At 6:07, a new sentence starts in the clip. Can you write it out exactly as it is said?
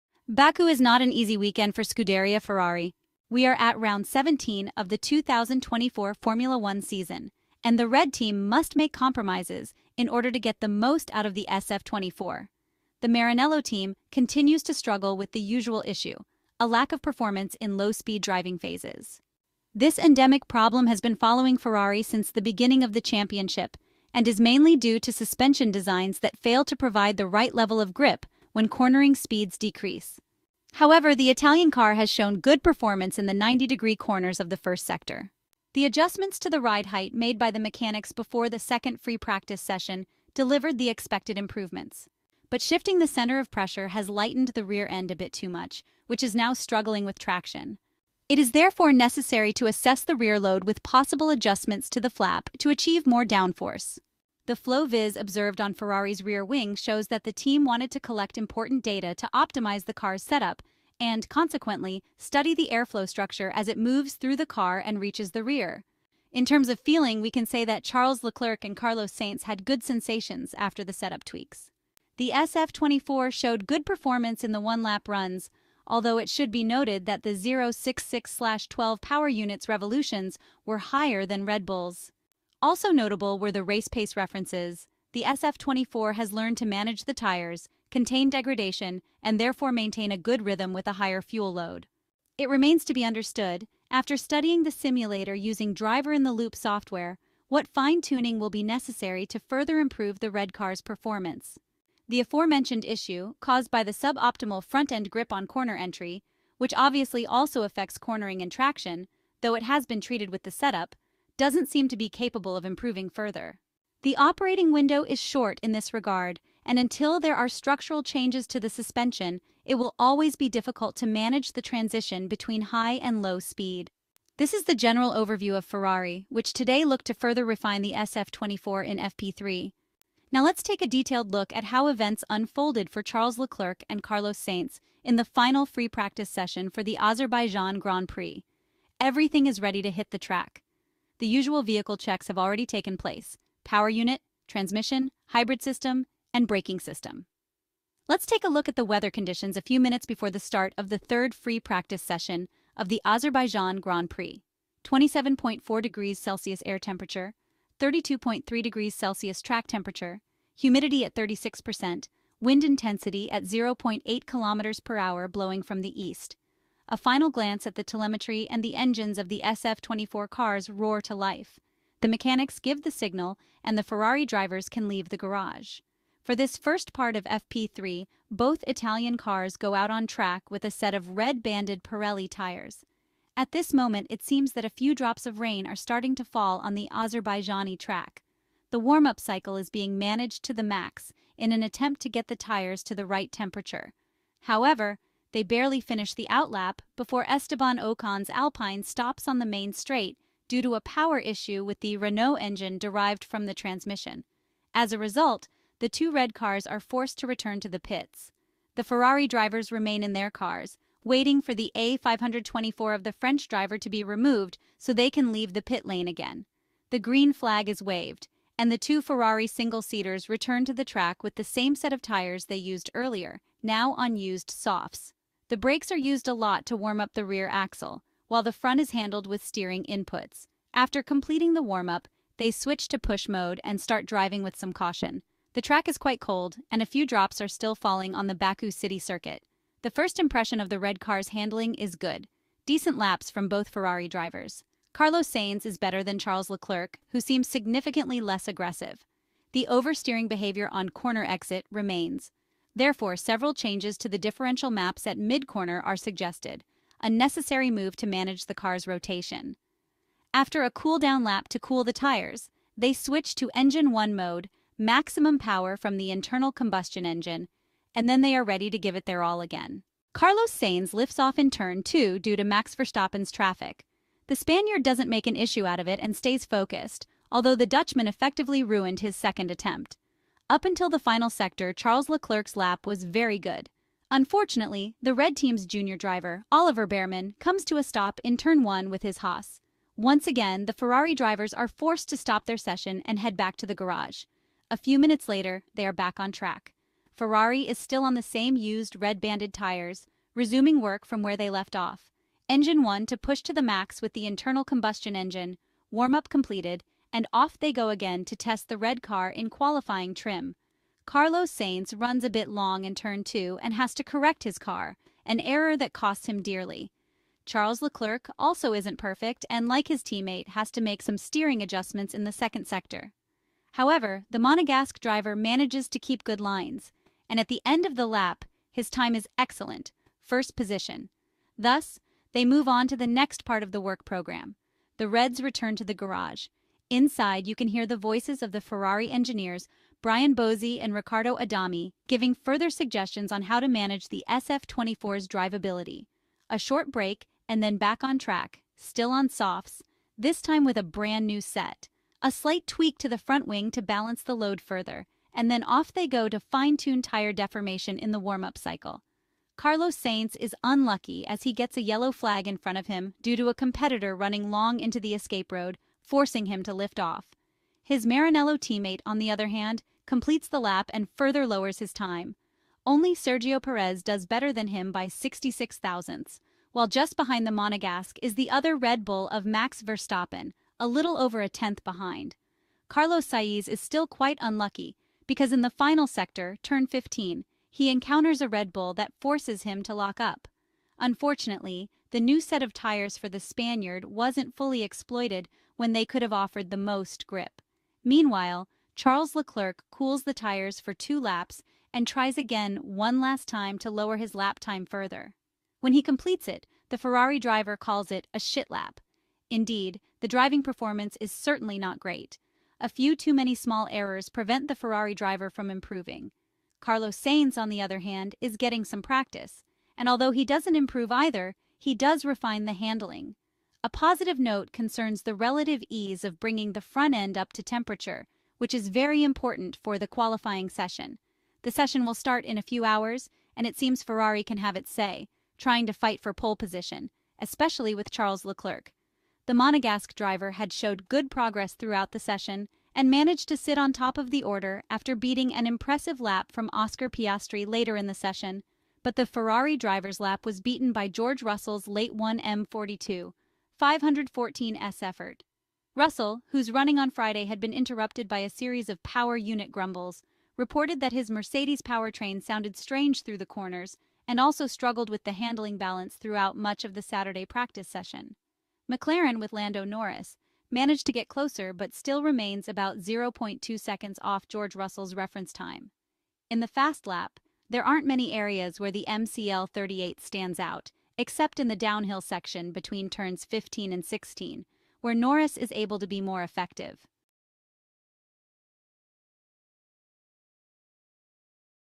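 His Maranello teammate, on the other hand, completes the lap and further lowers his time.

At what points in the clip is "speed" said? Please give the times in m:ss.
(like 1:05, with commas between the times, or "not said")
0:17, 0:29, 2:03.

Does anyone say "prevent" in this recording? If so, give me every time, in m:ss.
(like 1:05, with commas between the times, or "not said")
6:54.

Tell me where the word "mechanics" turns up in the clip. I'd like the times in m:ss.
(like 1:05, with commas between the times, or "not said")
0:37, 2:52.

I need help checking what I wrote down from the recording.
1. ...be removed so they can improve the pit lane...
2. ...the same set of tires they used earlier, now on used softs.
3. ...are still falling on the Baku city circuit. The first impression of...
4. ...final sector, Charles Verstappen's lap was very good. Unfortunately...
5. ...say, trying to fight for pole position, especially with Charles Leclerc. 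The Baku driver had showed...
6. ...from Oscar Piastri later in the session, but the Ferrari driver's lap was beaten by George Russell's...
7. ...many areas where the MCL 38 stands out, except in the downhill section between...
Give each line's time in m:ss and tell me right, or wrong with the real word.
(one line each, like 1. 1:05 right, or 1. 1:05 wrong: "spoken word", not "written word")
1. 3:33 wrong: "leave", not "improve"
2. 3:41 right
3. 3:57 right
4. 4:40 wrong: "Leclerc", not "Verstappen"
5. 7:14 wrong: "Monegasque", not "Baku"
6. 7:26 right
7. 7:58 right.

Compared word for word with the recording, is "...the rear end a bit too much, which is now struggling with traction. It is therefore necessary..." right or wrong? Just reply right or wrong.
right.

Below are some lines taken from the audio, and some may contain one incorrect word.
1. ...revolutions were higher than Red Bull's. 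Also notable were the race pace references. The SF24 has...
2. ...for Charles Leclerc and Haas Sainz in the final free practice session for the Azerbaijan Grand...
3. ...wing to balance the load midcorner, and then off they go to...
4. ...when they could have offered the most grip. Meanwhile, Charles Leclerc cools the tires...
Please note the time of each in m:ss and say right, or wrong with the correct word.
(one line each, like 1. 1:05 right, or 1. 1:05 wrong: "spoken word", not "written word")
1. 1:19 right
2. 2:12 wrong: "Carlos", not "Haas"
3. 5:53 wrong: "further", not "midcorner"
4. 6:35 right.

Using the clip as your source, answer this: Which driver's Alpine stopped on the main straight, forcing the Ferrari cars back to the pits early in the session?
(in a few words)
Esteban Ocon.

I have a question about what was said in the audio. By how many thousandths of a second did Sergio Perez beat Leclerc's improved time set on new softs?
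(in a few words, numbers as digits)
66.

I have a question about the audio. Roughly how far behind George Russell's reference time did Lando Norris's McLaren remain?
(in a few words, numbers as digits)
0.2 seconds.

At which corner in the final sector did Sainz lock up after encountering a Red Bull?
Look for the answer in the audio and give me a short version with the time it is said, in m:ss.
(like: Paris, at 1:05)
turn 15, at 6:26.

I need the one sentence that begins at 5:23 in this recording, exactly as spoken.
However, the Monegasque driver manages to keep good lines, and at the end of the lap, his time is excellent, first position.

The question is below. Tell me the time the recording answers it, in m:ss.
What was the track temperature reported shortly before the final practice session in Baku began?
2:37.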